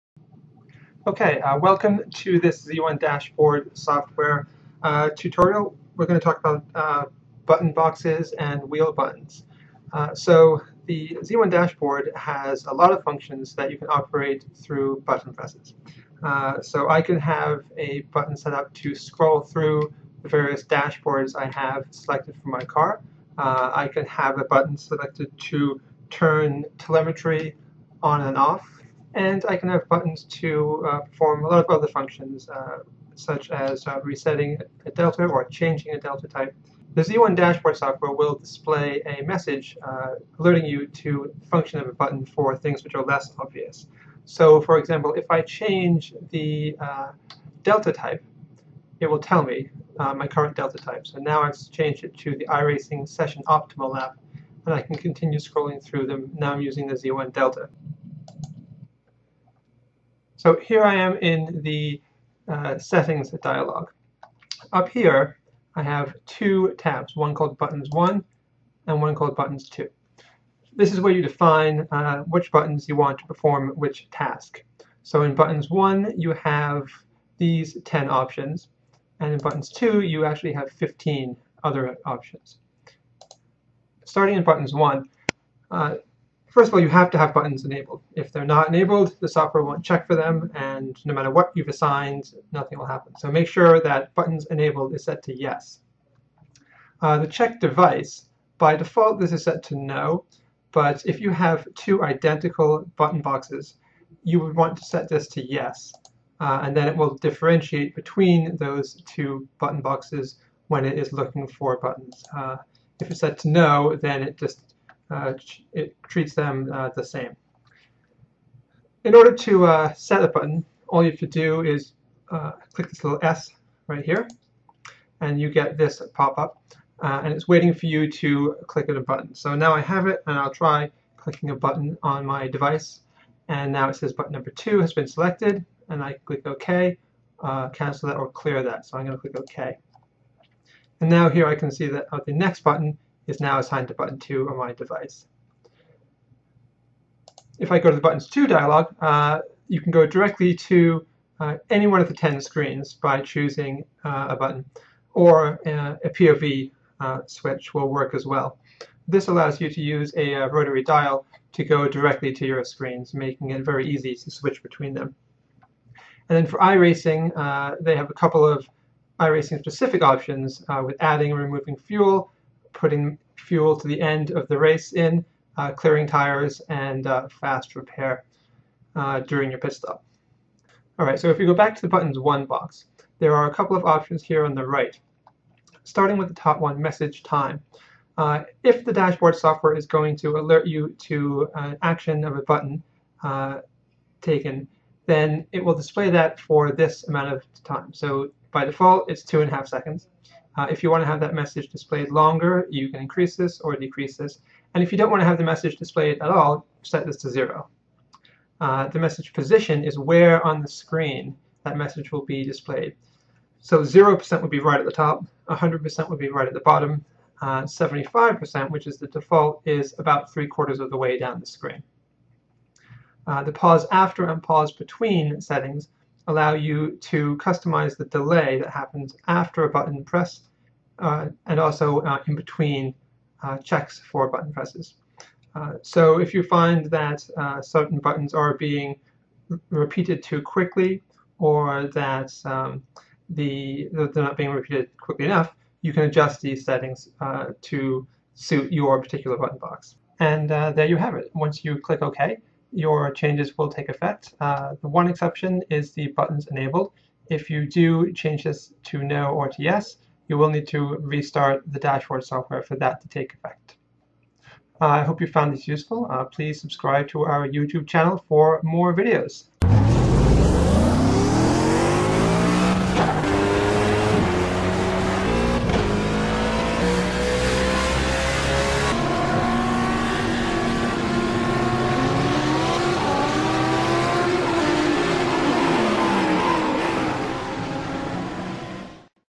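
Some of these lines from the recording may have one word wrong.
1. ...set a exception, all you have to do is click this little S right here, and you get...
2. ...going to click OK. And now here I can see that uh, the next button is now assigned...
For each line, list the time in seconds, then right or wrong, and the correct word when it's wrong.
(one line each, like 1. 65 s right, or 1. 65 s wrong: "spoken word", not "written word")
1. 119 s wrong: "button", not "exception"
2. 139 s right.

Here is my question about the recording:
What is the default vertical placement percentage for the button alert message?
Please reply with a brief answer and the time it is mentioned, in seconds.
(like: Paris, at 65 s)
75%, at 217 s.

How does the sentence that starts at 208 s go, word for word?
Uh, the message position is where on the screen that message will be displayed.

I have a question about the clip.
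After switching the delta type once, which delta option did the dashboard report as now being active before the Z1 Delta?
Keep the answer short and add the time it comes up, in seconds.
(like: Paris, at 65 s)
iRacing Session Optimal, at 52 s.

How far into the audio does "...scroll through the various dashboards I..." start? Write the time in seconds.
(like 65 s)
18 s.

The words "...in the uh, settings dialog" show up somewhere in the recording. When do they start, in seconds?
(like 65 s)
61 s.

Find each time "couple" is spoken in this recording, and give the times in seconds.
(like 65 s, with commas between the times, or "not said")
168 s, 183 s.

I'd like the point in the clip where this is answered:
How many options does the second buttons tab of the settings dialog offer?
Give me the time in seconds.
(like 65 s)
80 s.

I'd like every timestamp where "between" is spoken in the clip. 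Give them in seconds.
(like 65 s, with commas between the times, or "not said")
107 s, 164 s, 224 s, 232 s.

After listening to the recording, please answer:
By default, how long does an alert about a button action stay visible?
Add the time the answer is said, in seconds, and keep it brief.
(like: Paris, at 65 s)
2.5 seconds, at 199 s.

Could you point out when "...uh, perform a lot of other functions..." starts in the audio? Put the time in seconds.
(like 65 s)
30 s.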